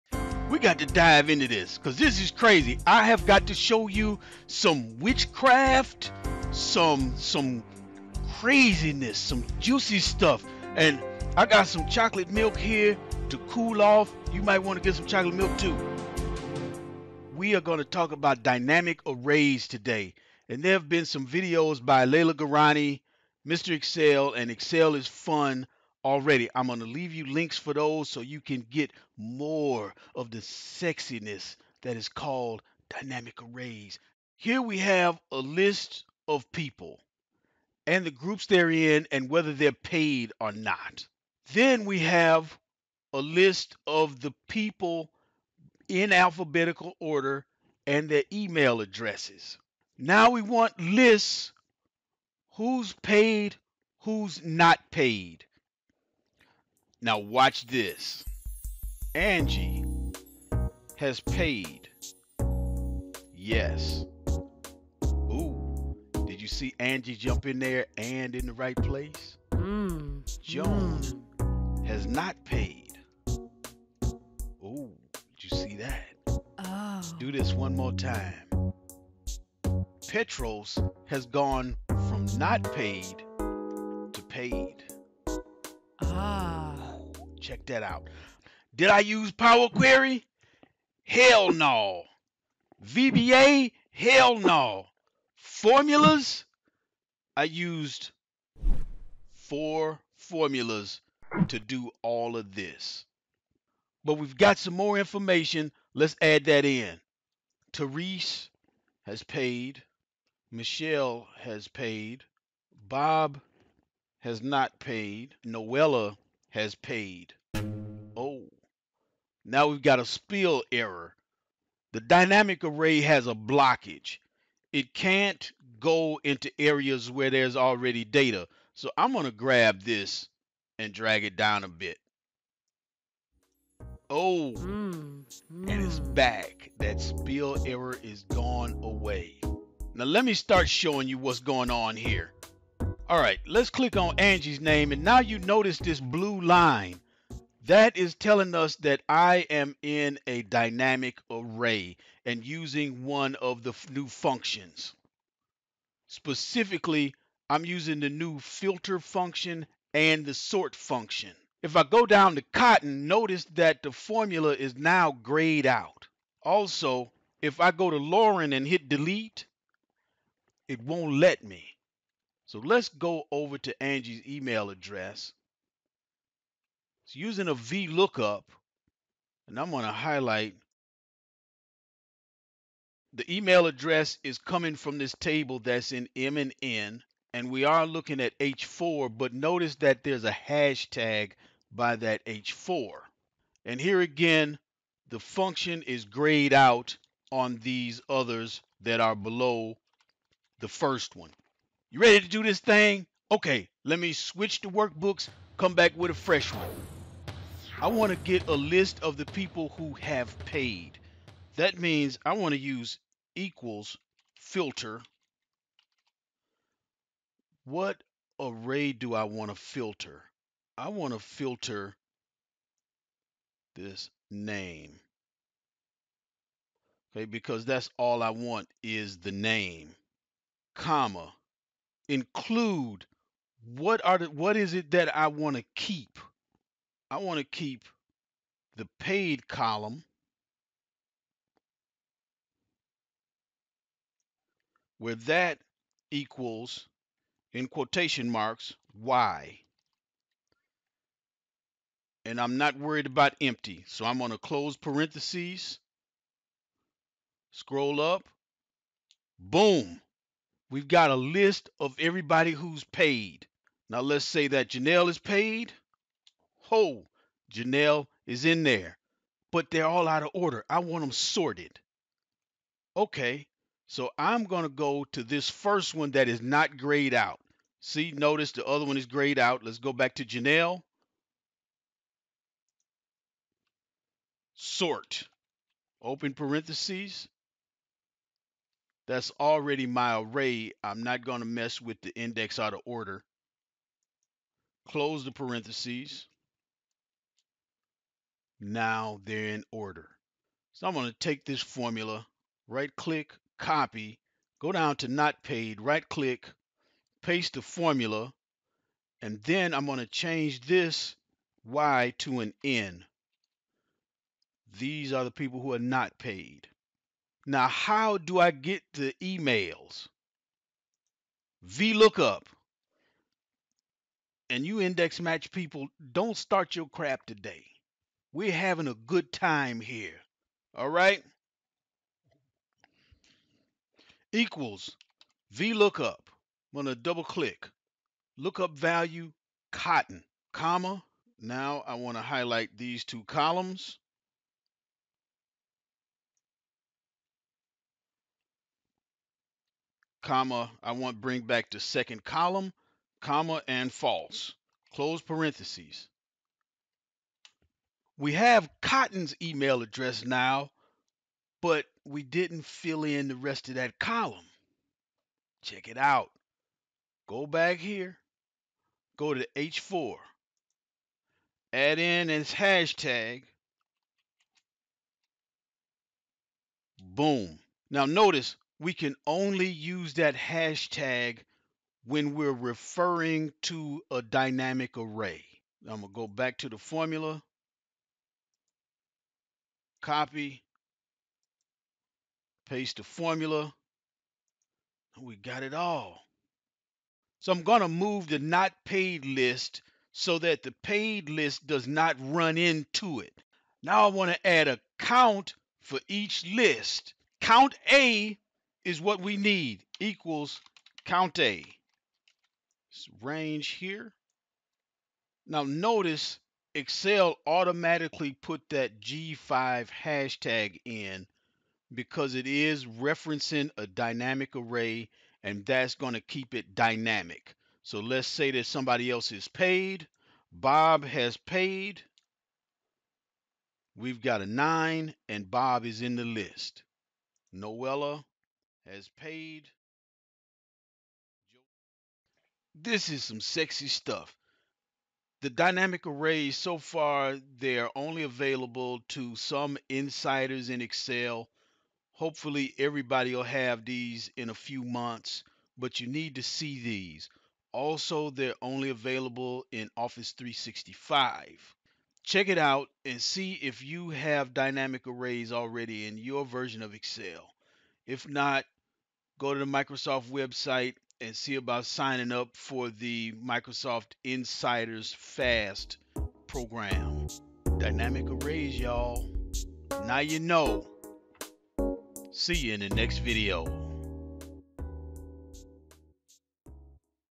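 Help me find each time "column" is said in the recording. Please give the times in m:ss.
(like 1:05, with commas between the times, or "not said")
3:59, 5:43, 5:52, 6:03.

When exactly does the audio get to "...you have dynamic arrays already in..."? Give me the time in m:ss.
7:43.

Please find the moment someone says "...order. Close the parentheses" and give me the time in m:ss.
4:52.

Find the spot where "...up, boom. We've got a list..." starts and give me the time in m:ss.
4:17.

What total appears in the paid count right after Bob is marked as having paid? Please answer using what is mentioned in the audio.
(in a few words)
9.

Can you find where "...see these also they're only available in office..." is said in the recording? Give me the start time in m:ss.
7:36.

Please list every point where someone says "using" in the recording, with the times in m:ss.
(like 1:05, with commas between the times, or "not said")
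2:32, 2:37, 2:57.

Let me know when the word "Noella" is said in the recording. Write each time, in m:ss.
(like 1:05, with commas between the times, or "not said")
1:55, 7:17.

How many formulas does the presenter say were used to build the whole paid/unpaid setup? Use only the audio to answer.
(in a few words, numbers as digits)
4.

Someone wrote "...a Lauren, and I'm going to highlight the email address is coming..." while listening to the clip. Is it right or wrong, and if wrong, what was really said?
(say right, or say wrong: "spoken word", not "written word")
wrong: "VLOOKUP", not "Lauren".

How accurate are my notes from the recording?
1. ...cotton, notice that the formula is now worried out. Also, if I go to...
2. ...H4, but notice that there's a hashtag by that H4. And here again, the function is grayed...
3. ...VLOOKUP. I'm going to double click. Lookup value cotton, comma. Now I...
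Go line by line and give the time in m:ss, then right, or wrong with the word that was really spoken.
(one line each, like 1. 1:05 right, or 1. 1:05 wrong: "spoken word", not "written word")
1. 2:42 wrong: "grayed", not "worried"
2. 3:08 right
3. 5:35 right.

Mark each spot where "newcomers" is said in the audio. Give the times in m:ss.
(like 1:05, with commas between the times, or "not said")
not said.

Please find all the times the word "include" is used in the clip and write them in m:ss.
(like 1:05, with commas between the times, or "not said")
3:52.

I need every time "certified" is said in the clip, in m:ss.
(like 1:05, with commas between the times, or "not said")
not said.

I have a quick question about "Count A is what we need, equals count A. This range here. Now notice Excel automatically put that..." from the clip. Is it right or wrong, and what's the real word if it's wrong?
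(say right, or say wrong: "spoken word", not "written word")
right.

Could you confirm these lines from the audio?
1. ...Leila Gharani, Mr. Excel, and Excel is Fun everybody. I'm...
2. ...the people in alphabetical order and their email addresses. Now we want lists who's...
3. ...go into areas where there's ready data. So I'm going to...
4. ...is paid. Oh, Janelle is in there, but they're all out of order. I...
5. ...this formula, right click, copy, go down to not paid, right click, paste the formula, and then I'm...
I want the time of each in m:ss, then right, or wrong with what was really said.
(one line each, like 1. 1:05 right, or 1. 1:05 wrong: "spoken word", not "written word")
1. 0:22 wrong: "already", not "everybody"
2. 0:44 right
3. 2:05 wrong: "already", not "ready"
4. 4:25 right
5. 5:01 right.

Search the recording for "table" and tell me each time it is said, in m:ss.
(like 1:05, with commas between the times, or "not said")
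3:05.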